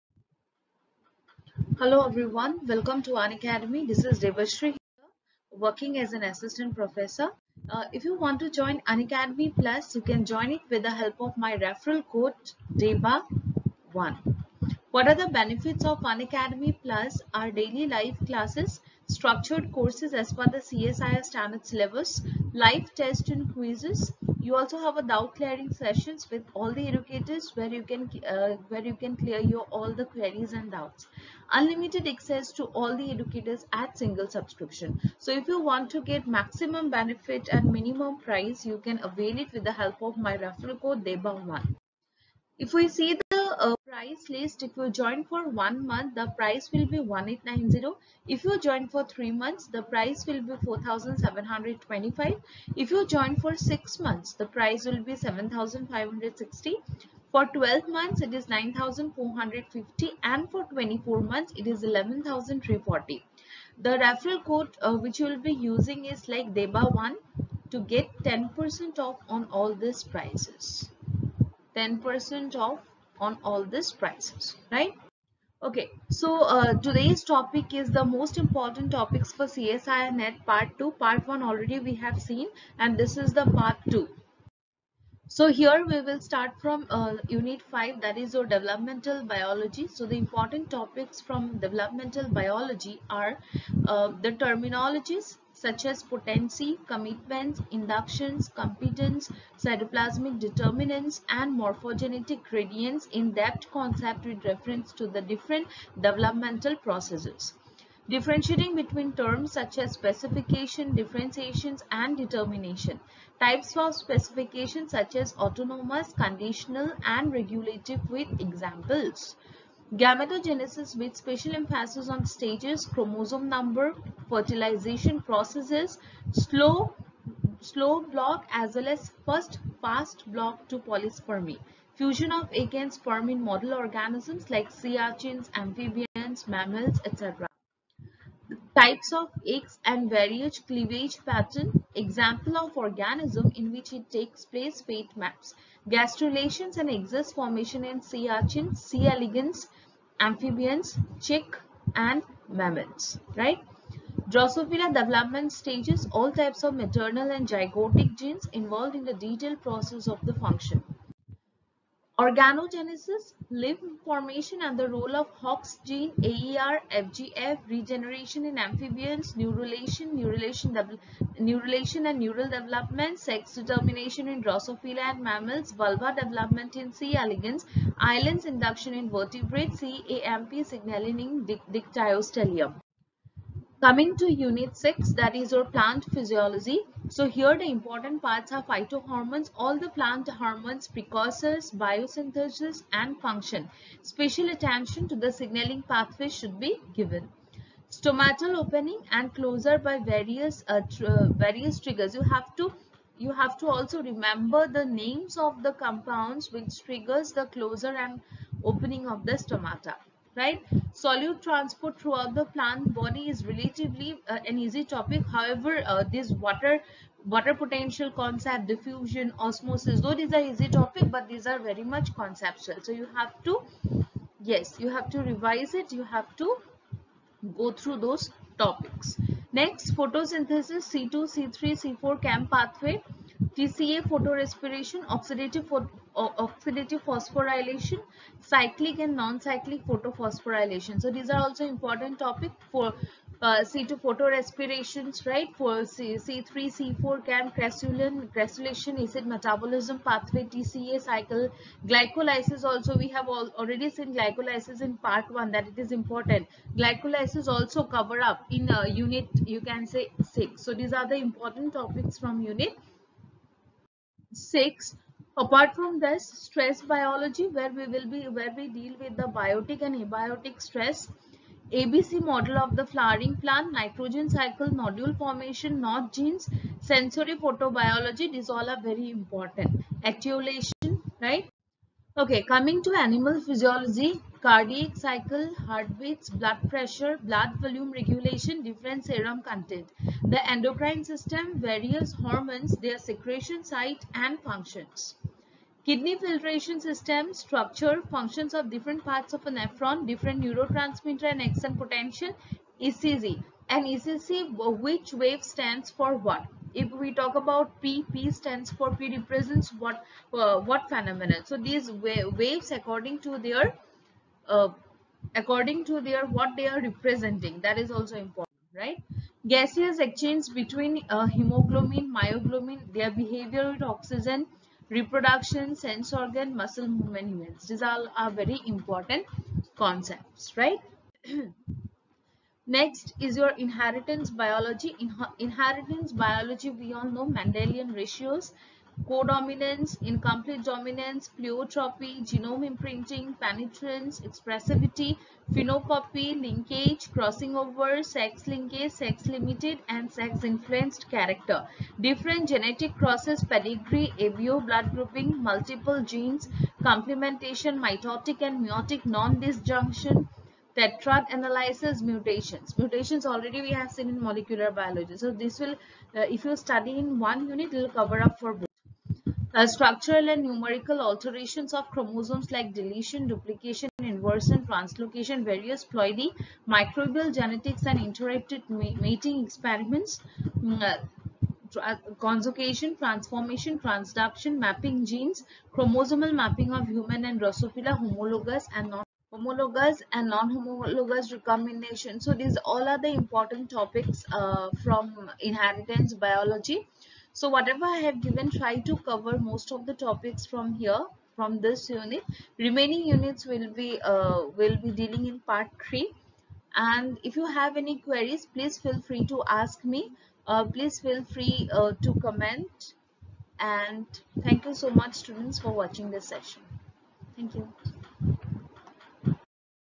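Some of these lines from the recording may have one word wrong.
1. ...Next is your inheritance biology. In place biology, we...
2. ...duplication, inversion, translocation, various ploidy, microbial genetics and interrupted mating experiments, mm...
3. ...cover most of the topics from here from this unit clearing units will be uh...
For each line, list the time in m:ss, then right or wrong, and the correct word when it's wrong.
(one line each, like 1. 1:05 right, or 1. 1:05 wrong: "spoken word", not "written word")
1. 5:32 wrong: "inheritance", not "place"
2. 6:13 right
3. 6:39 wrong: "remaining", not "clearing".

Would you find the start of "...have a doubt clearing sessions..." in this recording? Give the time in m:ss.
0:24.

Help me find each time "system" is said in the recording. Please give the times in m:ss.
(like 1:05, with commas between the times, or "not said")
4:51, 4:56.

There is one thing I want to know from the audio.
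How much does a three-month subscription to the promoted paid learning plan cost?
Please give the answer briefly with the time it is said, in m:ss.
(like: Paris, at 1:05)
4725, at 0:50.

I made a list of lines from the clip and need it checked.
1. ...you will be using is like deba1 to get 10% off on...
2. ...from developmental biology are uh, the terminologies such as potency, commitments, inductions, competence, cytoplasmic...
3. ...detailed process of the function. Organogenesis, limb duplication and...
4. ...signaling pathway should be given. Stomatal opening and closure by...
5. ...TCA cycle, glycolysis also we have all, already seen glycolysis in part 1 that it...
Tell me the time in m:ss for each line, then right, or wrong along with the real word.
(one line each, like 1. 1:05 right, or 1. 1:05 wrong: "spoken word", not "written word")
1. 1:05 right
2. 1:31 right
3. 2:39 wrong: "formation", not "duplication"
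4. 3:15 right
5. 4:10 right.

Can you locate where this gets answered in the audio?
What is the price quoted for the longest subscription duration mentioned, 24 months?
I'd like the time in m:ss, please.
1:01.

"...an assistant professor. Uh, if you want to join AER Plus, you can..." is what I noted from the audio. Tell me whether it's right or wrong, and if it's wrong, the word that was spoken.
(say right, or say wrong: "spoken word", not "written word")
wrong: "Unacademy", not "AER".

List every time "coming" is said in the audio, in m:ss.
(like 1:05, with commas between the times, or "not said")
3:03, 4:42.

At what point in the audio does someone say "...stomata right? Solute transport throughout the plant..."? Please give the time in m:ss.
3:29.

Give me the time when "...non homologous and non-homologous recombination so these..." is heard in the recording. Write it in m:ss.
6:28.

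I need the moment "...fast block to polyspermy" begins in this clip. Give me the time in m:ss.
2:09.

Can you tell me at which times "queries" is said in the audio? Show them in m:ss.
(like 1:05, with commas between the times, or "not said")
0:30, 6:48.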